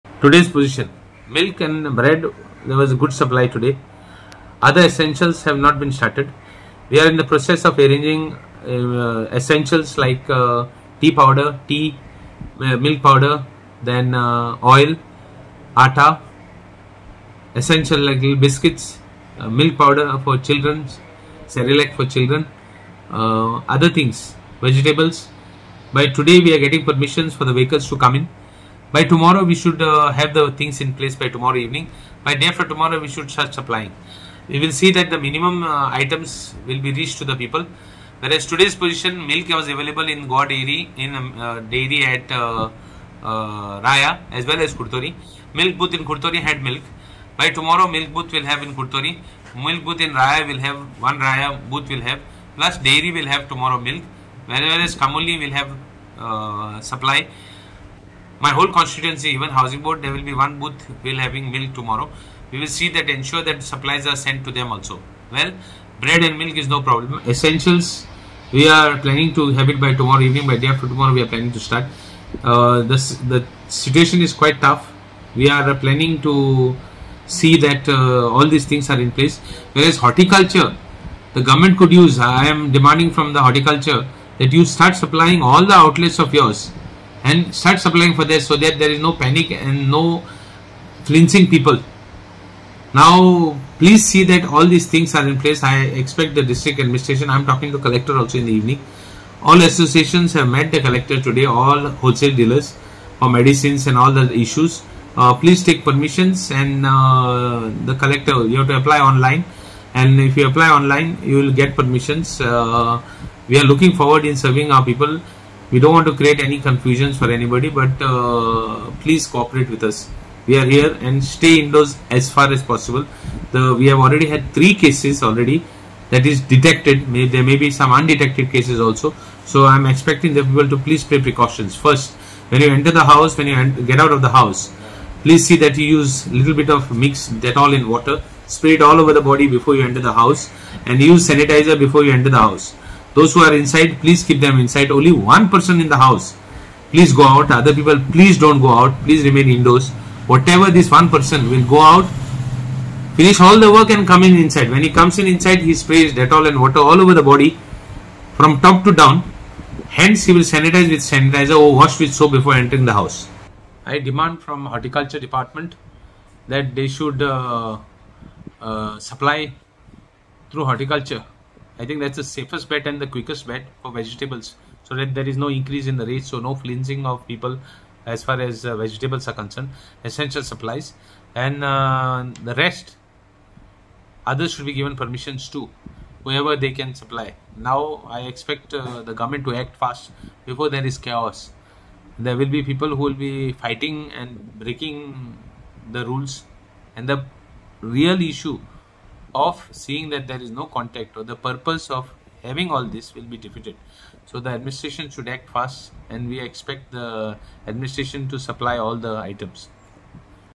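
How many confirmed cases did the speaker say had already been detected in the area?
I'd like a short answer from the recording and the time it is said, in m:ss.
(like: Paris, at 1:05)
3, at 2:04.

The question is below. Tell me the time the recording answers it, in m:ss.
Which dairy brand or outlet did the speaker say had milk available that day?
0:40.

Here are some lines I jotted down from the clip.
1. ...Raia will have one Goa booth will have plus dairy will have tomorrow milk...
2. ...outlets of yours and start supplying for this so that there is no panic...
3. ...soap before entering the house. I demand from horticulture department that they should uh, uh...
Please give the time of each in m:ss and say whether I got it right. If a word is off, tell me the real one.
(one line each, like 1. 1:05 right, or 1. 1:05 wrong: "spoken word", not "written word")
1. 0:50 wrong: "Raia", not "Goa"
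2. 1:25 right
3. 2:42 right.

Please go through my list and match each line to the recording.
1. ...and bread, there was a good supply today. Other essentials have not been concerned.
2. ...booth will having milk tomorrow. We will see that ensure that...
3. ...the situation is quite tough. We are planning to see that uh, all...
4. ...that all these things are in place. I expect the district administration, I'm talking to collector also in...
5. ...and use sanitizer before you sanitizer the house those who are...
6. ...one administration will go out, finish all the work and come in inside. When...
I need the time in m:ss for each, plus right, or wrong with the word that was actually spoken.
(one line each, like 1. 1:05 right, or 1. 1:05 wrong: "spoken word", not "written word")
1. 0:01 wrong: "started", not "concerned"
2. 1:00 right
3. 1:13 right
4. 1:34 right
5. 2:20 wrong: "enter", not "sanitizer"
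6. 2:30 wrong: "person", not "administration".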